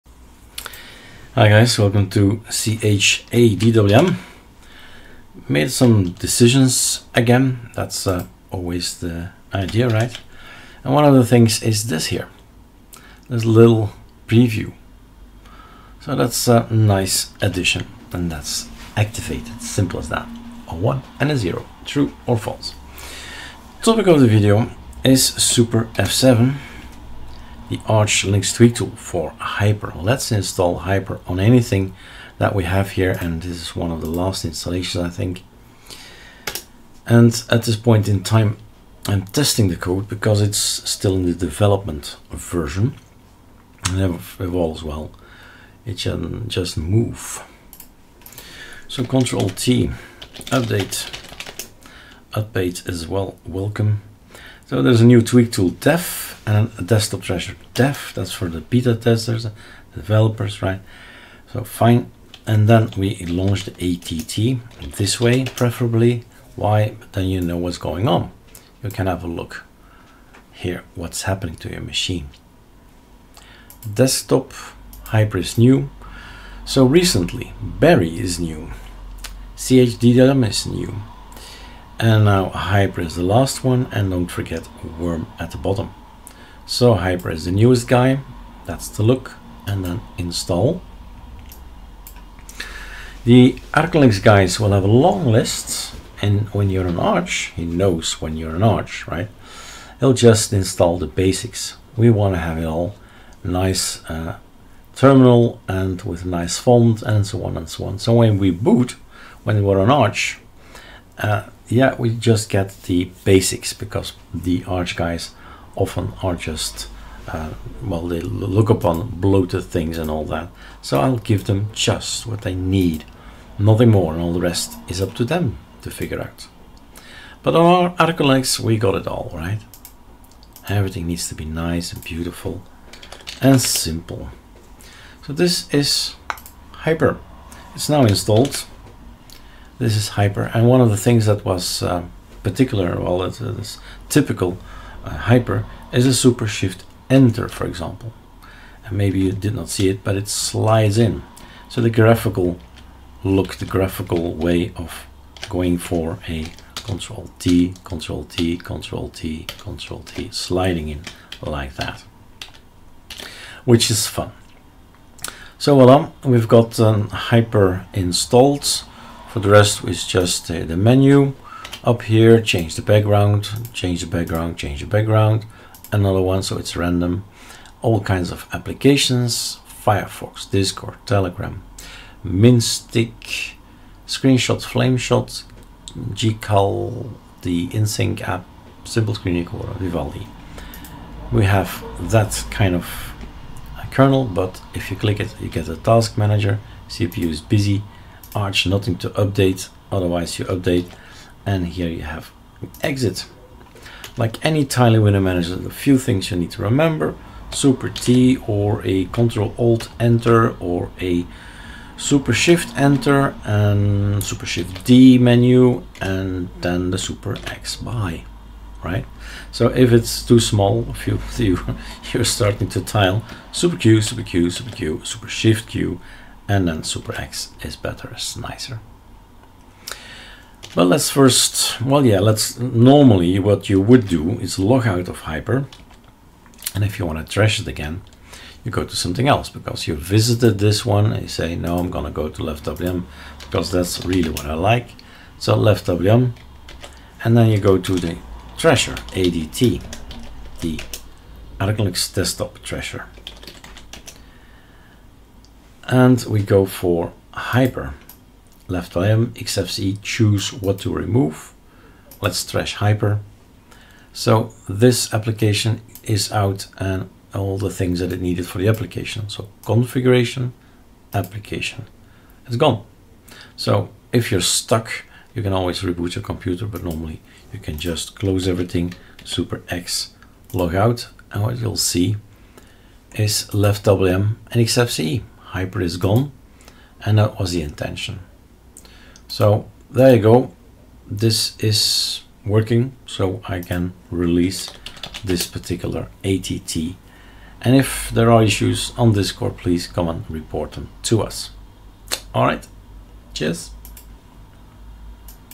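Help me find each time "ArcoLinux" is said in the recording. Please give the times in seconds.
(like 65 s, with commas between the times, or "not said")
27 s, 127 s.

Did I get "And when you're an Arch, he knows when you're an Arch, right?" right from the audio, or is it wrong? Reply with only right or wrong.
right.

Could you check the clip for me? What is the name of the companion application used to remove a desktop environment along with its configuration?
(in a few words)
Linux desktop trasher.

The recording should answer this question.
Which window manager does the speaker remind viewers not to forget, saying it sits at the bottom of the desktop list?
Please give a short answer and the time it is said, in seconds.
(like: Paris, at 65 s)
worm, at 84 s.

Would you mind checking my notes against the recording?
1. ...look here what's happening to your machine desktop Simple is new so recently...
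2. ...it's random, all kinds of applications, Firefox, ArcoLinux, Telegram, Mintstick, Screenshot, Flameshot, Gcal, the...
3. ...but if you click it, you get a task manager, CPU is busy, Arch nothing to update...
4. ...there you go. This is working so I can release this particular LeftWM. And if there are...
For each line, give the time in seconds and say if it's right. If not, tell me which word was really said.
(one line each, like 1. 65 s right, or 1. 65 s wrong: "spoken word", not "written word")
1. 69 s wrong: "Hypr", not "Simple"
2. 176 s wrong: "Discord", not "ArcoLinux"
3. 194 s right
4. 289 s wrong: "ATT", not "LeftWM".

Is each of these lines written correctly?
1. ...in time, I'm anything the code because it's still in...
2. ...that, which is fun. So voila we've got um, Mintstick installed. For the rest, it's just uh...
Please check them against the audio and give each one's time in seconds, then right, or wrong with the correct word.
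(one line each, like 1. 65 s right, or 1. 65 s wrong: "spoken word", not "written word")
1. 38 s wrong: "testing", not "anything"
2. 161 s wrong: "Hypr", not "Mintstick".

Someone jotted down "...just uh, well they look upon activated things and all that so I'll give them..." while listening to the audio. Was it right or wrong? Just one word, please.
wrong.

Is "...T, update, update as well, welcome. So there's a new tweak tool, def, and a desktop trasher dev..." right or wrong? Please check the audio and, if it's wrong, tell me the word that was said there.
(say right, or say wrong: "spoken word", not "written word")
right.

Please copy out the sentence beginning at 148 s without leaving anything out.
And maybe you did not see it, but it slides in.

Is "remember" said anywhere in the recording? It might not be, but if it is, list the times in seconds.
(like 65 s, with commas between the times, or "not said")
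206 s.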